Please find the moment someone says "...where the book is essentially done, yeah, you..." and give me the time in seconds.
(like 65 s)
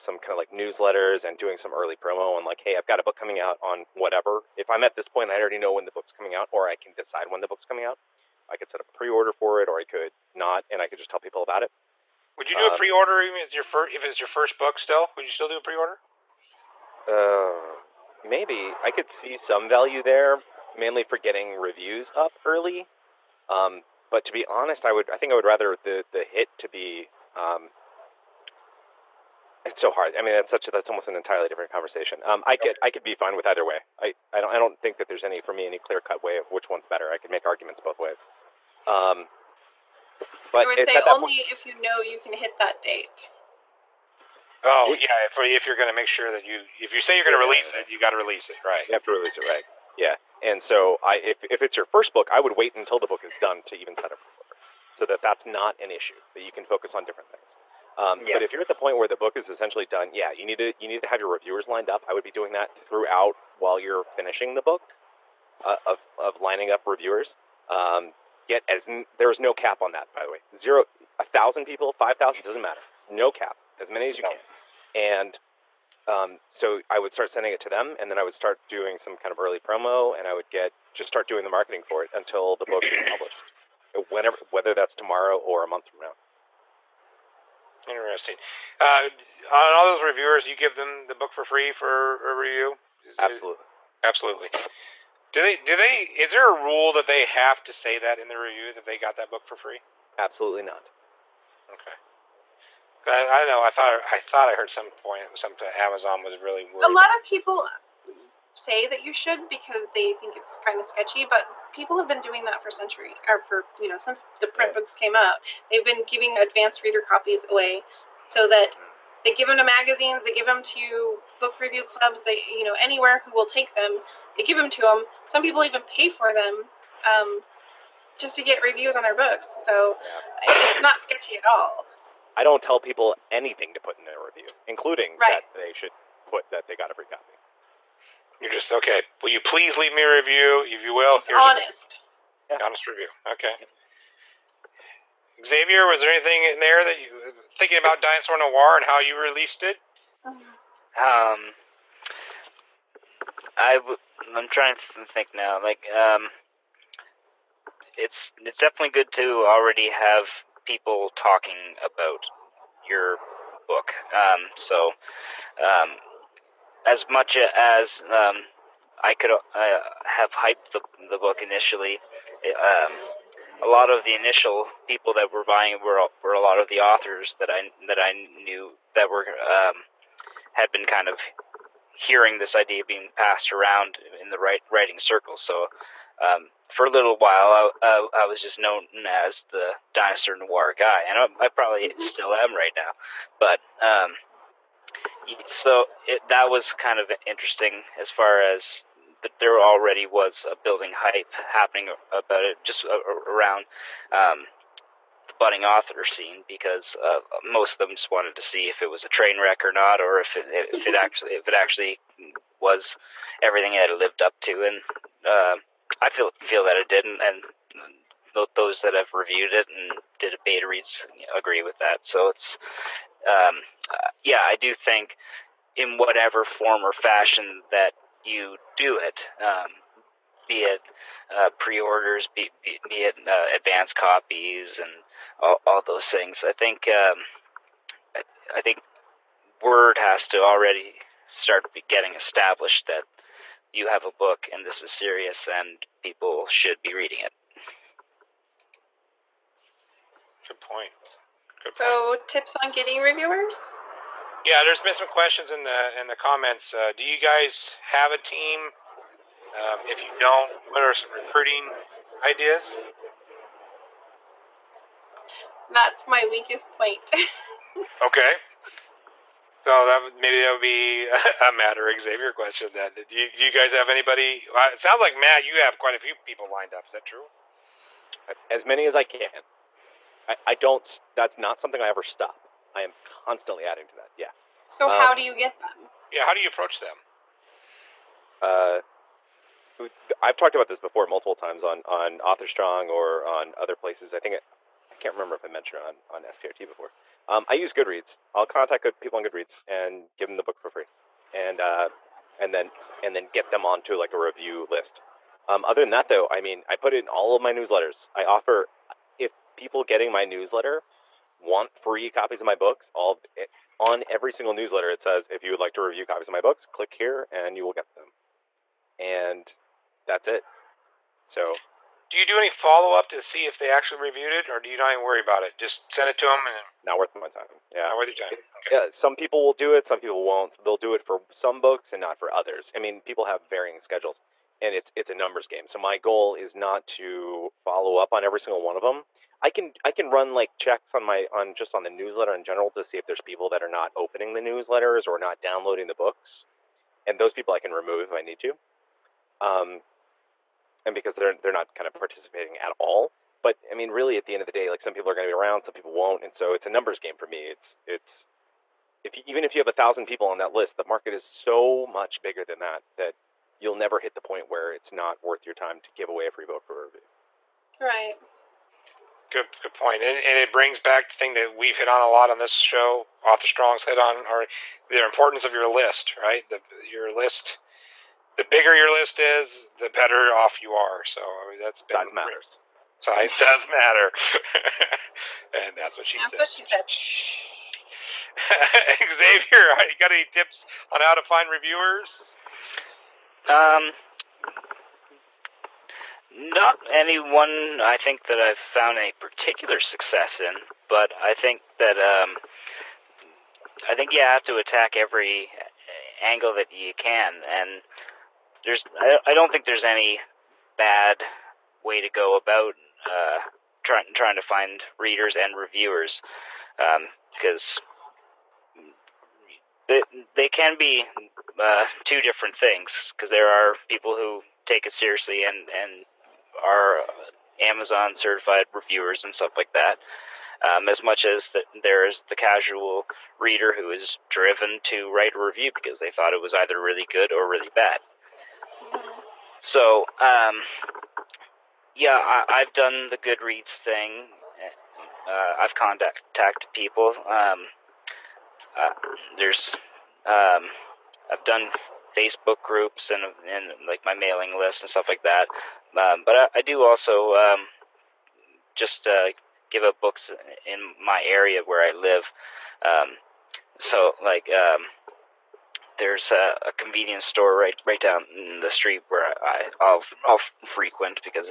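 58 s.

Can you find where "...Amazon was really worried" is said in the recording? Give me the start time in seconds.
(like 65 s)
105 s.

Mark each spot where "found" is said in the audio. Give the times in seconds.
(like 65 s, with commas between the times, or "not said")
398 s.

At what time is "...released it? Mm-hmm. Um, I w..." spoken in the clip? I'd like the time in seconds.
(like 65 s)
149 s.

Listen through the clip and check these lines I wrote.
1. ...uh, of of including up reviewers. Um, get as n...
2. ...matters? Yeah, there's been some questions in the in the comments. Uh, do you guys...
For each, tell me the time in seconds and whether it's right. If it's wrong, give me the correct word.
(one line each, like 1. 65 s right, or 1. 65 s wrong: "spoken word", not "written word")
1. 65 s wrong: "lining", not "including"
2. 253 s wrong: "reviewers", not "matters".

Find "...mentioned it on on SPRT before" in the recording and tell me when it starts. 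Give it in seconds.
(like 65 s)
295 s.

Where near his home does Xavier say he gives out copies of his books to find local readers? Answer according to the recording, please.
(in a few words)
A convenience store.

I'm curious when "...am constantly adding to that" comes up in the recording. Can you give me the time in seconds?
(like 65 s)
282 s.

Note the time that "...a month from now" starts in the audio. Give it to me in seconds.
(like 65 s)
85 s.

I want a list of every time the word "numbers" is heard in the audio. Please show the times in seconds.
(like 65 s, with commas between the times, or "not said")
335 s, 356 s.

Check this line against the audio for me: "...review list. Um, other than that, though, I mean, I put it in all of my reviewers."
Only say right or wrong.
wrong.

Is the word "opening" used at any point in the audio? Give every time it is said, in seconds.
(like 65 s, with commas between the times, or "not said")
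343 s.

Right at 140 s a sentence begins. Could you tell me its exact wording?
If you will, just here's honest.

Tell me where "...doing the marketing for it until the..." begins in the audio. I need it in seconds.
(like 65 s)
81 s.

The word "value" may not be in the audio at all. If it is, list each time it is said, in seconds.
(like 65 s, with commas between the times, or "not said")
19 s.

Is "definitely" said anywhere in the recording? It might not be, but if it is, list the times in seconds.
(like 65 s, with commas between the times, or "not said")
158 s.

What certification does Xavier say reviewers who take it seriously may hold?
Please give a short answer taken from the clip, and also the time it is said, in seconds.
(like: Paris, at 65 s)
Amazon certified reviewers, at 427 s.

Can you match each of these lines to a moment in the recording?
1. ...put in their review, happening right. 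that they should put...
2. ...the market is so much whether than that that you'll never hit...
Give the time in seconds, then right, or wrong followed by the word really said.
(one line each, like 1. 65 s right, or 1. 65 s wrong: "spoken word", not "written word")
1. 133 s wrong: "including", not "happening"
2. 360 s wrong: "bigger", not "whether".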